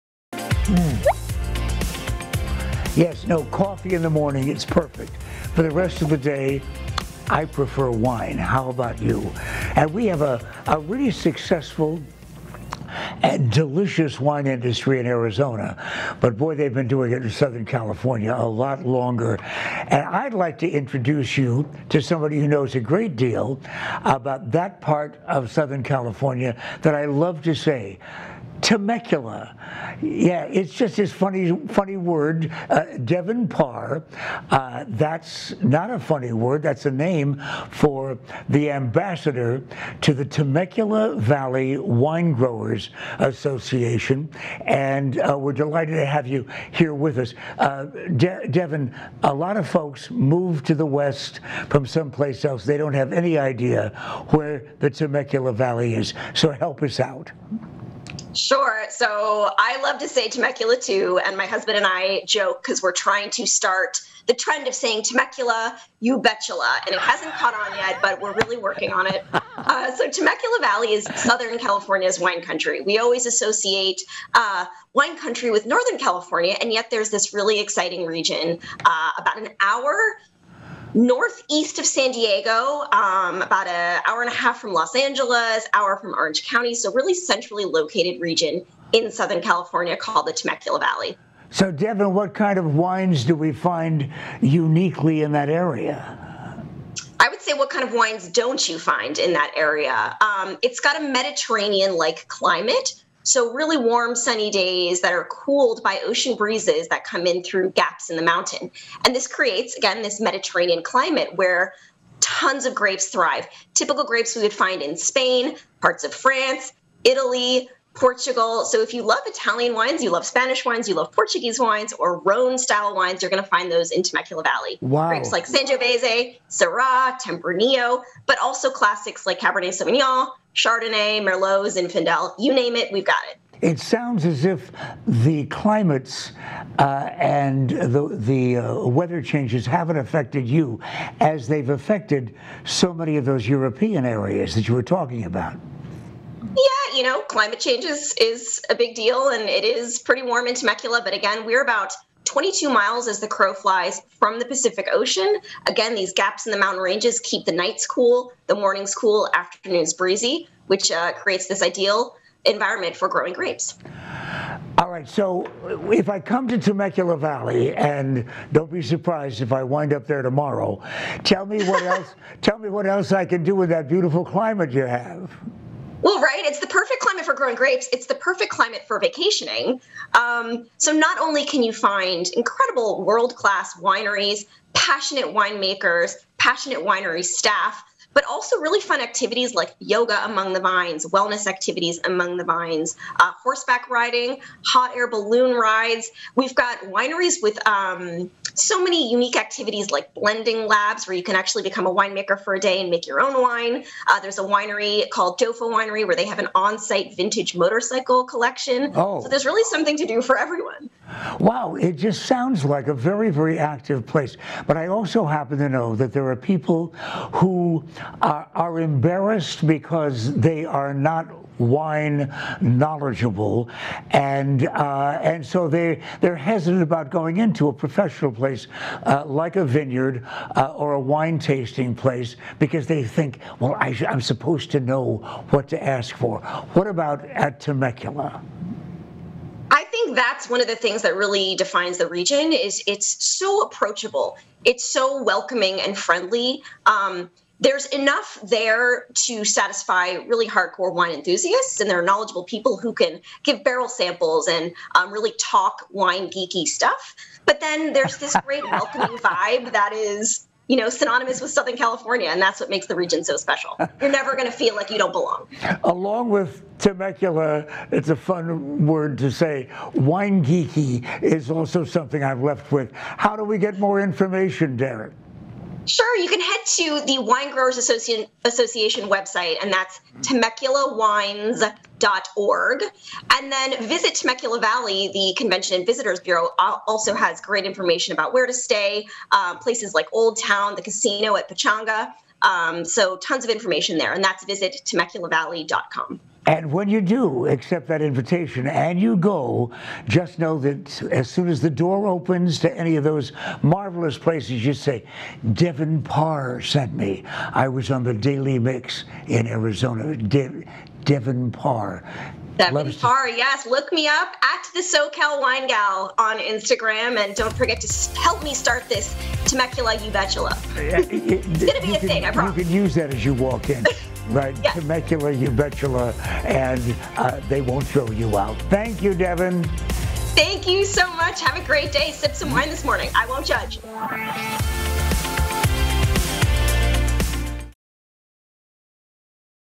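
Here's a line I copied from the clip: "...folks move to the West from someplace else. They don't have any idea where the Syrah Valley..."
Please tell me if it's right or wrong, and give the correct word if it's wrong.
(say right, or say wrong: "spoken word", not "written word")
wrong: "Temecula", not "Syrah".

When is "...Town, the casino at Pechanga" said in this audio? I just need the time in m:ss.
4:50.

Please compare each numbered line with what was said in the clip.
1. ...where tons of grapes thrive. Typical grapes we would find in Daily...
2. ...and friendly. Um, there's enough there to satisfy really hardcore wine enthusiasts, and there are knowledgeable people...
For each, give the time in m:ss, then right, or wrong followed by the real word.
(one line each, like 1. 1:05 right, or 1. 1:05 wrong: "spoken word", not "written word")
1. 1:51 wrong: "Spain", not "Daily"
2. 4:05 right.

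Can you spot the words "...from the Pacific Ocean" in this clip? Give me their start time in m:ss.
2:34.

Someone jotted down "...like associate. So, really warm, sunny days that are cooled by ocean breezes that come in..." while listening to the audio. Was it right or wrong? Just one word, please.
wrong.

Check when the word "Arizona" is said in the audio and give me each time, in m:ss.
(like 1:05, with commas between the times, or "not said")
0:15, 5:09.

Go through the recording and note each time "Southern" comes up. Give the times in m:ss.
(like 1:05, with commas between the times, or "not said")
0:17, 0:25, 1:11, 1:29, 4:21.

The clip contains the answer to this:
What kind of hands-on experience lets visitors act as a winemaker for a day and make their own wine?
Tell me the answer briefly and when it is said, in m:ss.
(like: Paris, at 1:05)
Blending labs, at 3:20.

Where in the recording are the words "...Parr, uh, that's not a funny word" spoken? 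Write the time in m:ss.
0:33.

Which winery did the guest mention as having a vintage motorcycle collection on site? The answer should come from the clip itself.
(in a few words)
Doffo Winery.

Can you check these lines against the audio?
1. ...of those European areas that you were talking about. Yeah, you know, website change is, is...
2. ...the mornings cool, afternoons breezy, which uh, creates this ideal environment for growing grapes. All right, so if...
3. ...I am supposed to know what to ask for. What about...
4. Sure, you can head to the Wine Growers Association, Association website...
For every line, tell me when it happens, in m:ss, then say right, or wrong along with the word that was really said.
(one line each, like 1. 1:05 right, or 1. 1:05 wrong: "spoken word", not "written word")
1. 2:23 wrong: "climate", not "website"
2. 2:38 right
3. 3:53 right
4. 4:35 right.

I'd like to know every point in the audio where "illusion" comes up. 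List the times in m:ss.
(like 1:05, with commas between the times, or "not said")
not said.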